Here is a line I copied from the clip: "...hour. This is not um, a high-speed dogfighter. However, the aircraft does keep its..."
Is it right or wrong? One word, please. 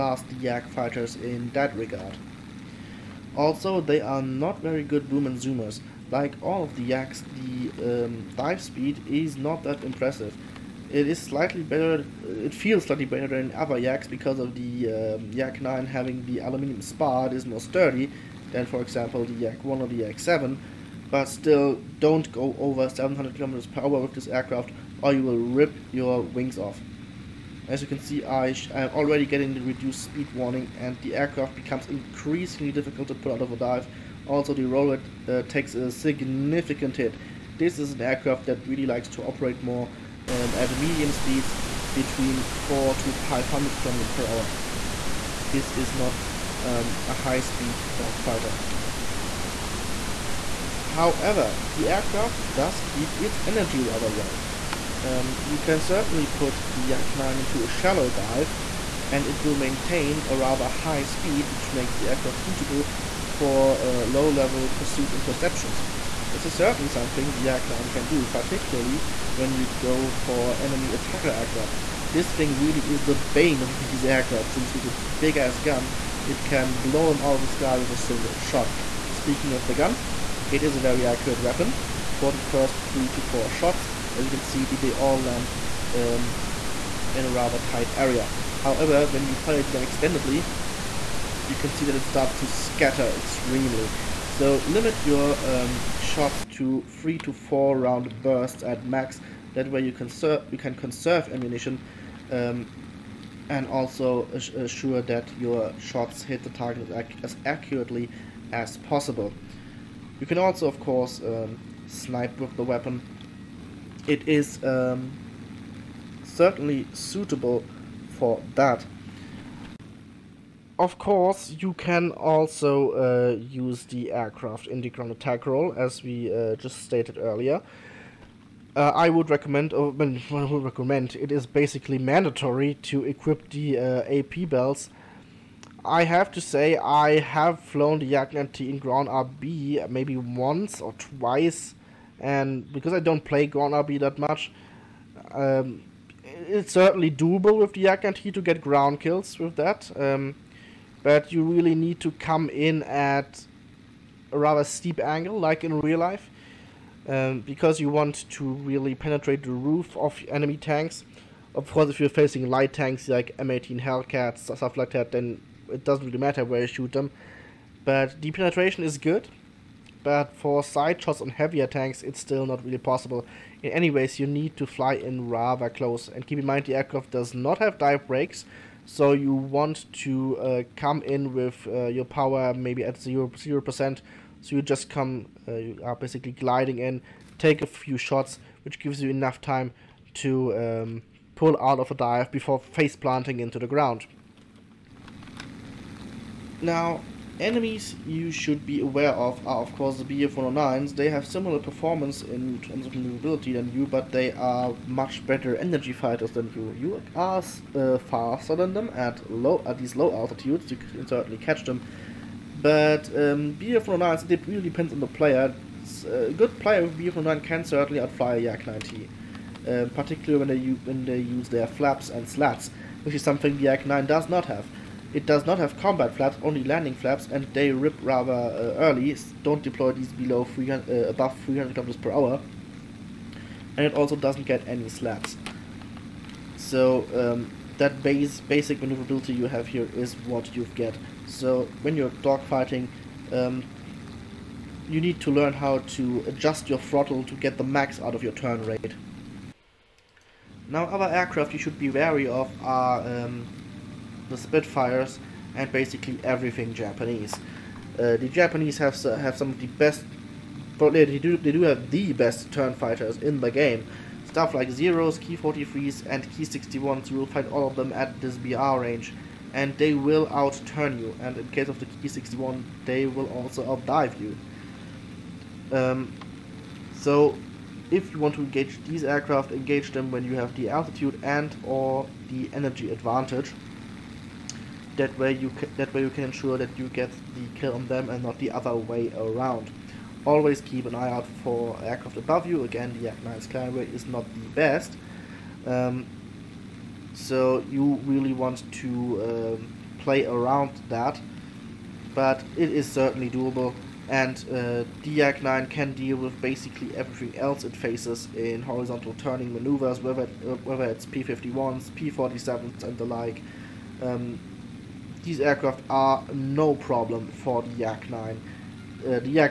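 right.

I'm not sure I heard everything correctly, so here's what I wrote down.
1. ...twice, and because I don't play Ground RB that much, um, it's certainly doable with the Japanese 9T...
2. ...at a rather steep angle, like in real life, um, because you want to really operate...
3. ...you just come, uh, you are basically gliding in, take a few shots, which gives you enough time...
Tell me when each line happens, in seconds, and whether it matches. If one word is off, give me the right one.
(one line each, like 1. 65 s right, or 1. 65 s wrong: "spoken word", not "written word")
1. 140 s wrong: "Yak", not "Japanese"
2. 152 s wrong: "penetrate", not "operate"
3. 184 s right.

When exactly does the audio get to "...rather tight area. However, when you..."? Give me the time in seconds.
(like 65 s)
87 s.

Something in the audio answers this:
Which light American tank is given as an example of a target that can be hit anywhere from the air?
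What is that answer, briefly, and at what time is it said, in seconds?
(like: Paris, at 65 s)
M18 Hellcat, at 163 s.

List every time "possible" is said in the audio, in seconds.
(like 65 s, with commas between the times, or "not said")
108 s, 172 s.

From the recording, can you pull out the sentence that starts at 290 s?
Always keep an eye out for aircraft above you.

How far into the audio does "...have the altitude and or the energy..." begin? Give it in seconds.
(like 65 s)
280 s.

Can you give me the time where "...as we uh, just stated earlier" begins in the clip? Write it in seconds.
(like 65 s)
125 s.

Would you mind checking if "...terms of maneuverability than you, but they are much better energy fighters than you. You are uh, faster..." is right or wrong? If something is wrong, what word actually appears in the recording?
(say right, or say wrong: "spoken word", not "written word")
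right.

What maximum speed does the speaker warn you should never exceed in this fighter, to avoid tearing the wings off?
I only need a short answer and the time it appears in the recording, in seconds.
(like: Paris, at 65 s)
700 km/h, at 22 s.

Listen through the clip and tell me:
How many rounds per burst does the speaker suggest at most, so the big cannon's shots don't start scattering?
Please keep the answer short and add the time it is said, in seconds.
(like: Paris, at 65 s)
3 to 4, at 96 s.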